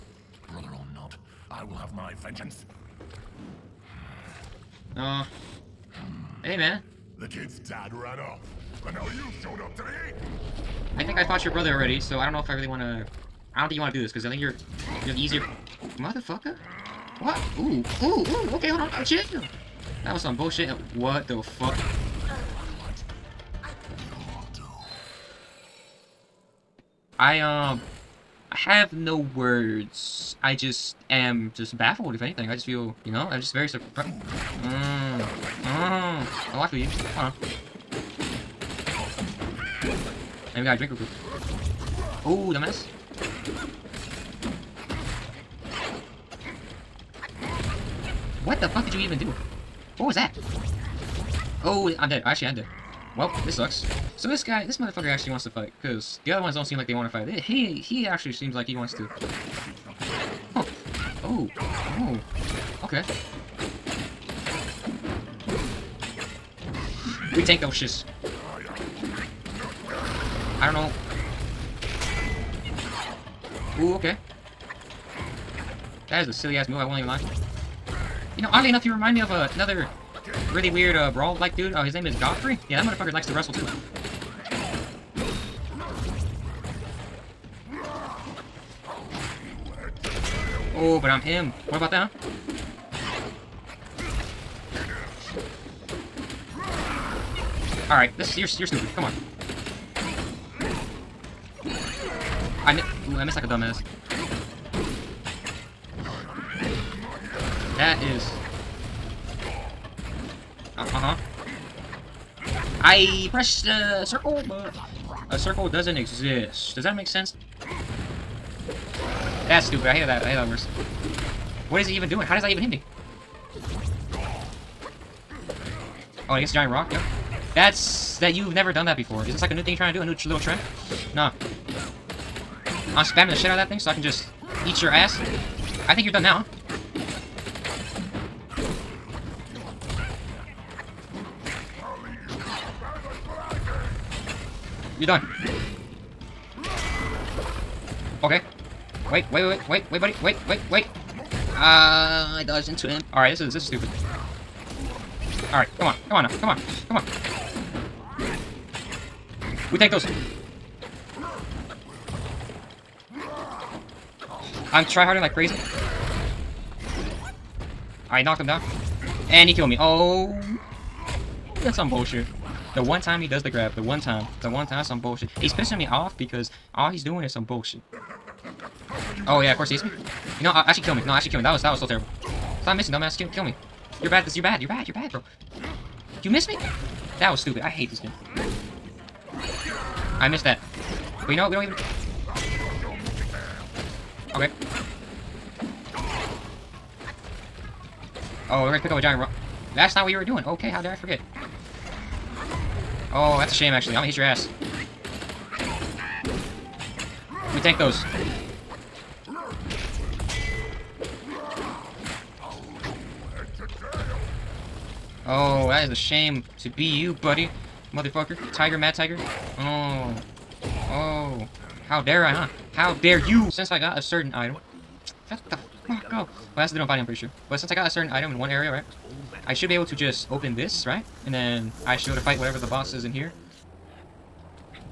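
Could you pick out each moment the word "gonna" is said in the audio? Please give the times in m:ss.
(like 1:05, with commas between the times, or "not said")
3:18, 3:23.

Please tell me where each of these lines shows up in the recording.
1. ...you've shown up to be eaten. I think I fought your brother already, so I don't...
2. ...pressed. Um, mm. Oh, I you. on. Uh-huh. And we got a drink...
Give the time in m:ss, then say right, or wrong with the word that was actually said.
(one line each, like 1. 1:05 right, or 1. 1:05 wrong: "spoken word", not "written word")
1. 0:09 right
2. 0:33 wrong: "surprised", not "pressed".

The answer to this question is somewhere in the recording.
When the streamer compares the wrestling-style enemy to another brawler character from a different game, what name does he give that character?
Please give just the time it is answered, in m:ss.
1:22.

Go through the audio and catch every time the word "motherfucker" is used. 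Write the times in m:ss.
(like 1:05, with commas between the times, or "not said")
0:15, 0:54, 1:22, 3:37.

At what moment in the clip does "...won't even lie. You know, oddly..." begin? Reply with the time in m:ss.
1:16.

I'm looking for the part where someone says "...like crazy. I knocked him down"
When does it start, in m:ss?
2:45.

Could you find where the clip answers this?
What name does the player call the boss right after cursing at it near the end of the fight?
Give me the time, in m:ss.
3:38.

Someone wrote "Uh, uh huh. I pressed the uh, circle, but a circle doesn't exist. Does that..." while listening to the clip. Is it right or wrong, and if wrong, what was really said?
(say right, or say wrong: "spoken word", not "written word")
right.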